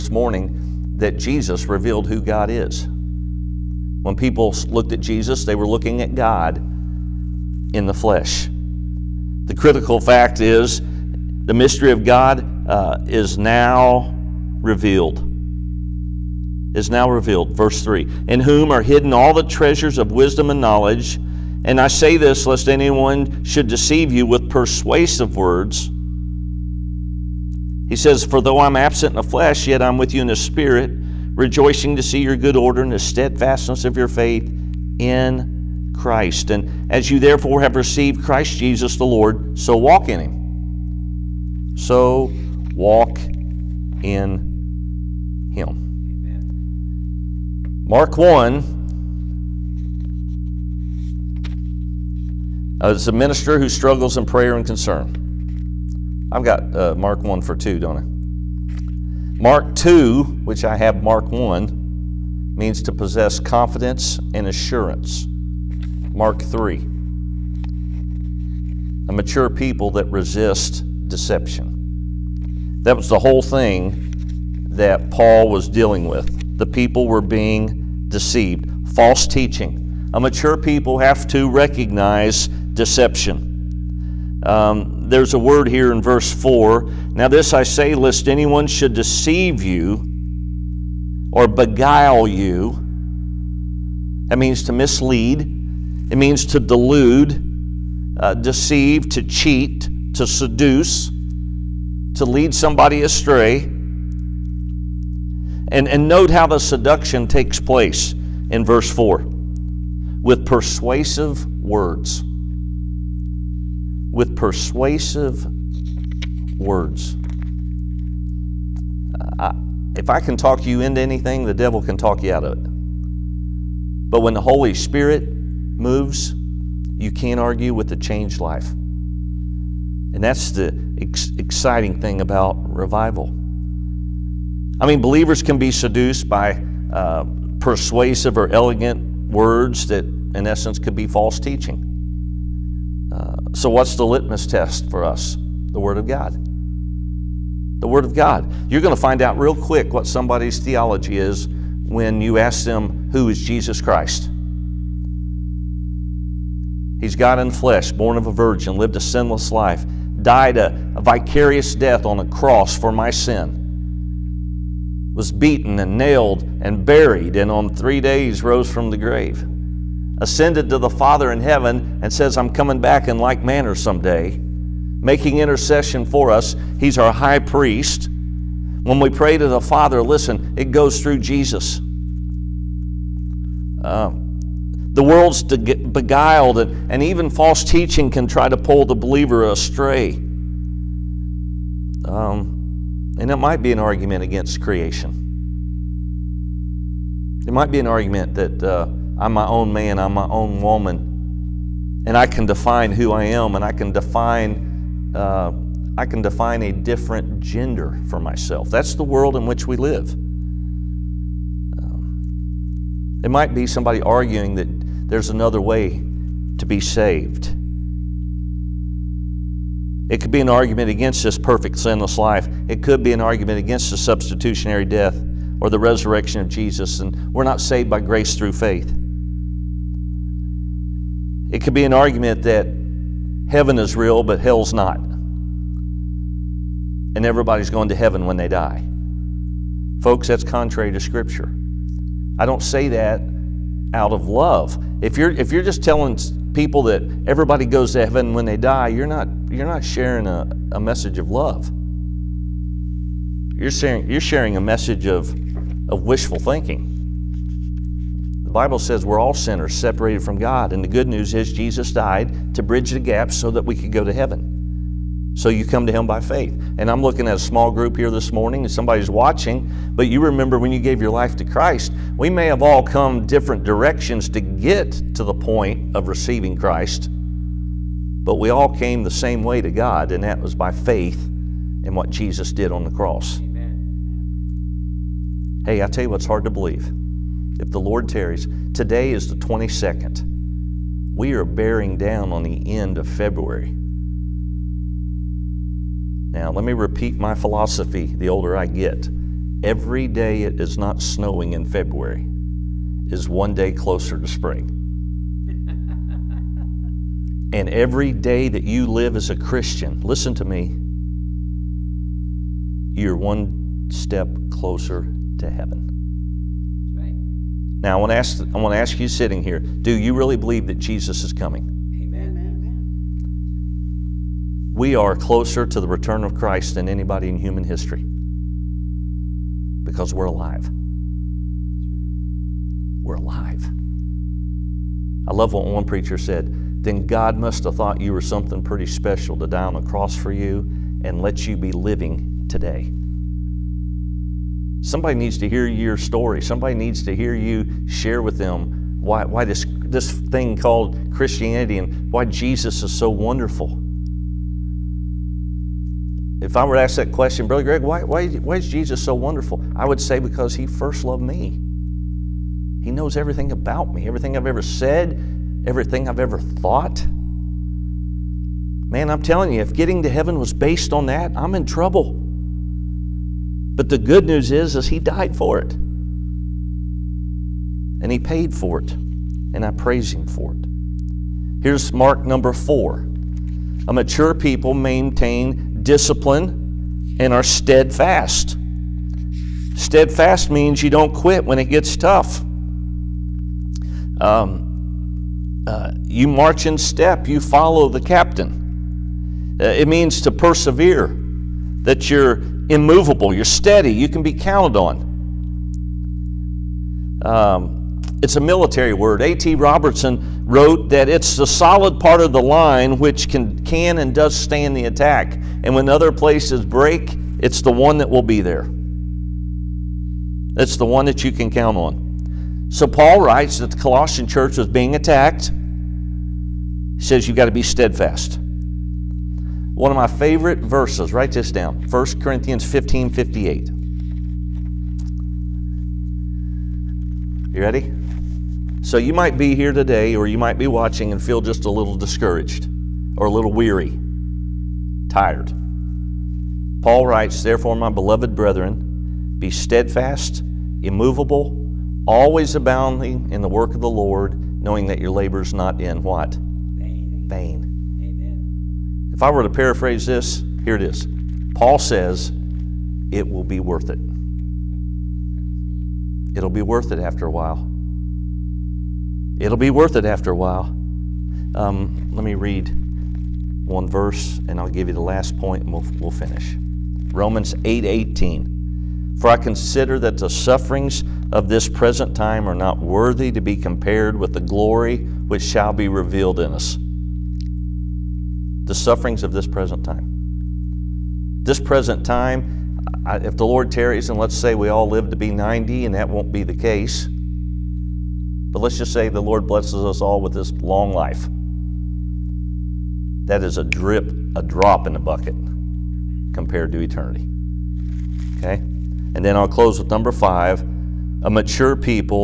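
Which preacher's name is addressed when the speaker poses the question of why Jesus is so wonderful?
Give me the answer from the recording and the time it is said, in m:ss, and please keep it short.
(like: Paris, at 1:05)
Brother Greg, at 5:57.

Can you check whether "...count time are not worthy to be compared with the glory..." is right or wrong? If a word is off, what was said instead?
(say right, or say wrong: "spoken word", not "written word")
wrong: "present", not "count".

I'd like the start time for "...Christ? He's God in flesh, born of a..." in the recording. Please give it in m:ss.
2:33.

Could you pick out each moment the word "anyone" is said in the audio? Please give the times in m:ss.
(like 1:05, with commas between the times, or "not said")
0:22, 1:28.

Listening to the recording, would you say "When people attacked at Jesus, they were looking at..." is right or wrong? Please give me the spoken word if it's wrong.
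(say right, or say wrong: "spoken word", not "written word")
wrong: "looked", not "attacked".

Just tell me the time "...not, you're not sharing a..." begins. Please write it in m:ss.
4:09.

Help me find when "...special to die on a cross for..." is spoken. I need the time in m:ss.
5:38.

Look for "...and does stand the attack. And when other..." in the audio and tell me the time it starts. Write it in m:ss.
6:53.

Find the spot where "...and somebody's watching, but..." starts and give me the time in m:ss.
4:28.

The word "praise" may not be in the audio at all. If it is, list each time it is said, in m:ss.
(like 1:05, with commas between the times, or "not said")
6:19.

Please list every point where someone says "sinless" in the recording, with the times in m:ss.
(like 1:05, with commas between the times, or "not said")
2:38, 3:41.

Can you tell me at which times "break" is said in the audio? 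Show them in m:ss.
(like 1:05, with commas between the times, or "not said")
6:56.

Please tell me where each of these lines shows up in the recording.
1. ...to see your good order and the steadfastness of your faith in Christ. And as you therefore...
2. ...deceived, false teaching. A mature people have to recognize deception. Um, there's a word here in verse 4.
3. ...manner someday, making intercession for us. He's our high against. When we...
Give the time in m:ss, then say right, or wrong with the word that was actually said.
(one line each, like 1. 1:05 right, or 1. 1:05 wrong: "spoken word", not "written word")
1. 0:31 right
2. 1:18 right
3. 2:53 wrong: "priest", not "against".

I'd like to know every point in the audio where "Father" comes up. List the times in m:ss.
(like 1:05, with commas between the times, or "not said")
2:50, 2:59.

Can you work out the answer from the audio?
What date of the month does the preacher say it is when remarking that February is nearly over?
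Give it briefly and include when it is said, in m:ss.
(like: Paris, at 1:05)
22nd, at 4:49.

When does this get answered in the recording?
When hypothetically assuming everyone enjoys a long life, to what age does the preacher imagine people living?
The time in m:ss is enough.
8:15.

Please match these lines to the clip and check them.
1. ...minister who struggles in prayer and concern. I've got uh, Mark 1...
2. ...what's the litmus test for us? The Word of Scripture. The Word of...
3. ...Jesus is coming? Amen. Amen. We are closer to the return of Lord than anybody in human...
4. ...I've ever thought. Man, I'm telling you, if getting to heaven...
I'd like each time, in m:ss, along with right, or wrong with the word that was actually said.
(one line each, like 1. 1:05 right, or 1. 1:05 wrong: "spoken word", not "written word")
1. 0:53 right
2. 2:23 wrong: "God", not "Scripture"
3. 5:20 wrong: "Christ", not "Lord"
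4. 6:06 right.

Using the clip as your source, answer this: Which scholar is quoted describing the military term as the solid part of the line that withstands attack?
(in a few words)
A.T. Robertson.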